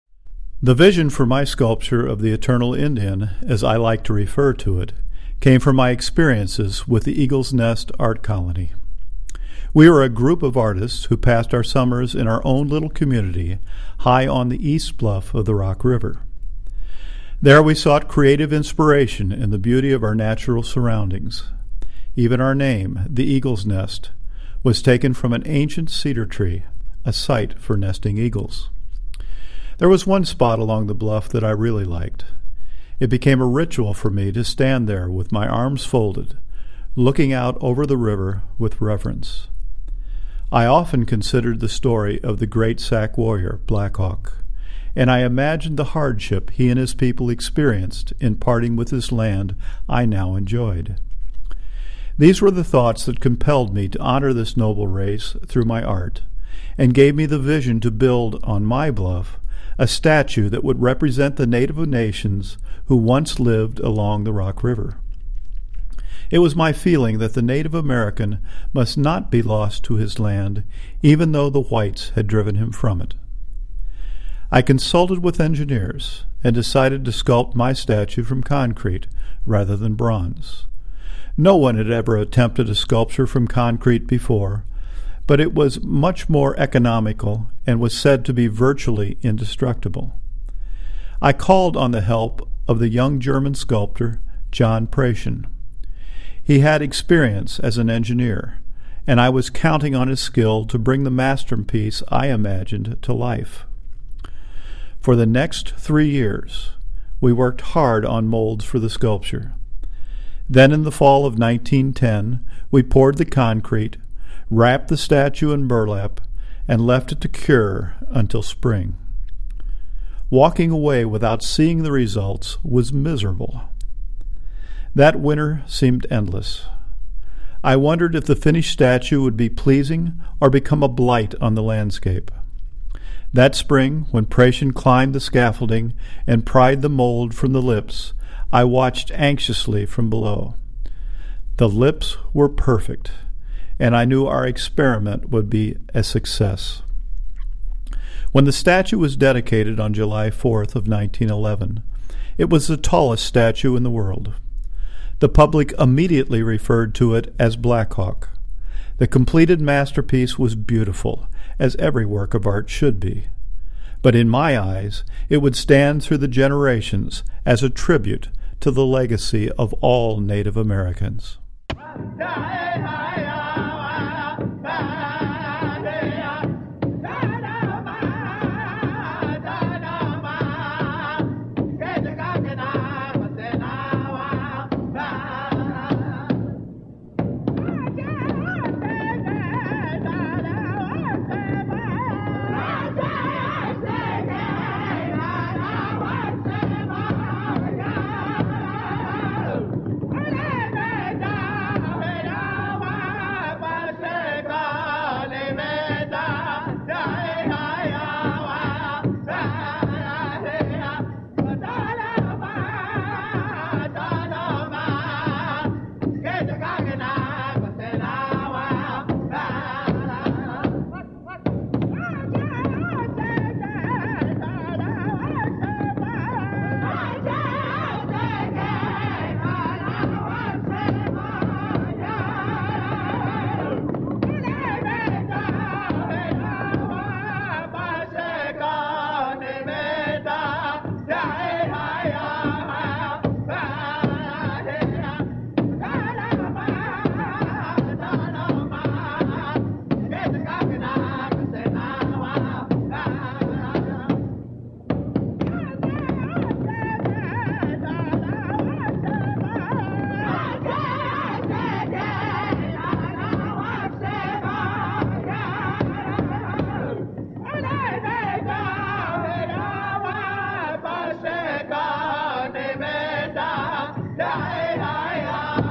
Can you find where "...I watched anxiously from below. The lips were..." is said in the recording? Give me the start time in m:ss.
2:18.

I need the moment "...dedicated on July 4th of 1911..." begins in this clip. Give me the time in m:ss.
2:29.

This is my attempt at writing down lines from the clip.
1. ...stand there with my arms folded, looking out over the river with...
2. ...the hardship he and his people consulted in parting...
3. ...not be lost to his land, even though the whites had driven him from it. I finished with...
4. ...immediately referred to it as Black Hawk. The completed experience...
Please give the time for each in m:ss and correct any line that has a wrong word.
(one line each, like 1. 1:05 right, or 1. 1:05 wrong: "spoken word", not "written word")
1. 0:34 right
2. 0:45 wrong: "experienced", not "consulted"
3. 1:08 wrong: "consulted", not "finished"
4. 2:35 wrong: "masterpiece", not "experience".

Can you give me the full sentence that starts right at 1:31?
I called on the help of the young German sculptor John Prasuhn.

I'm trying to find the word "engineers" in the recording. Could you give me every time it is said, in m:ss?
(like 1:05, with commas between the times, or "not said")
1:15, 1:37.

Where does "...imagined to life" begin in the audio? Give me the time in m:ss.
1:42.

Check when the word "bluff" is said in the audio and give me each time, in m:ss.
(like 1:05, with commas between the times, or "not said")
0:14, 0:30, 0:58.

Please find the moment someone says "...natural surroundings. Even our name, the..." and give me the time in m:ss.
0:20.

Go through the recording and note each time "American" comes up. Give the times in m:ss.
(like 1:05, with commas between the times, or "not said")
1:07, 2:50.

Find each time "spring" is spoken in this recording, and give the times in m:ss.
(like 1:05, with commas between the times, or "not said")
1:58, 2:13.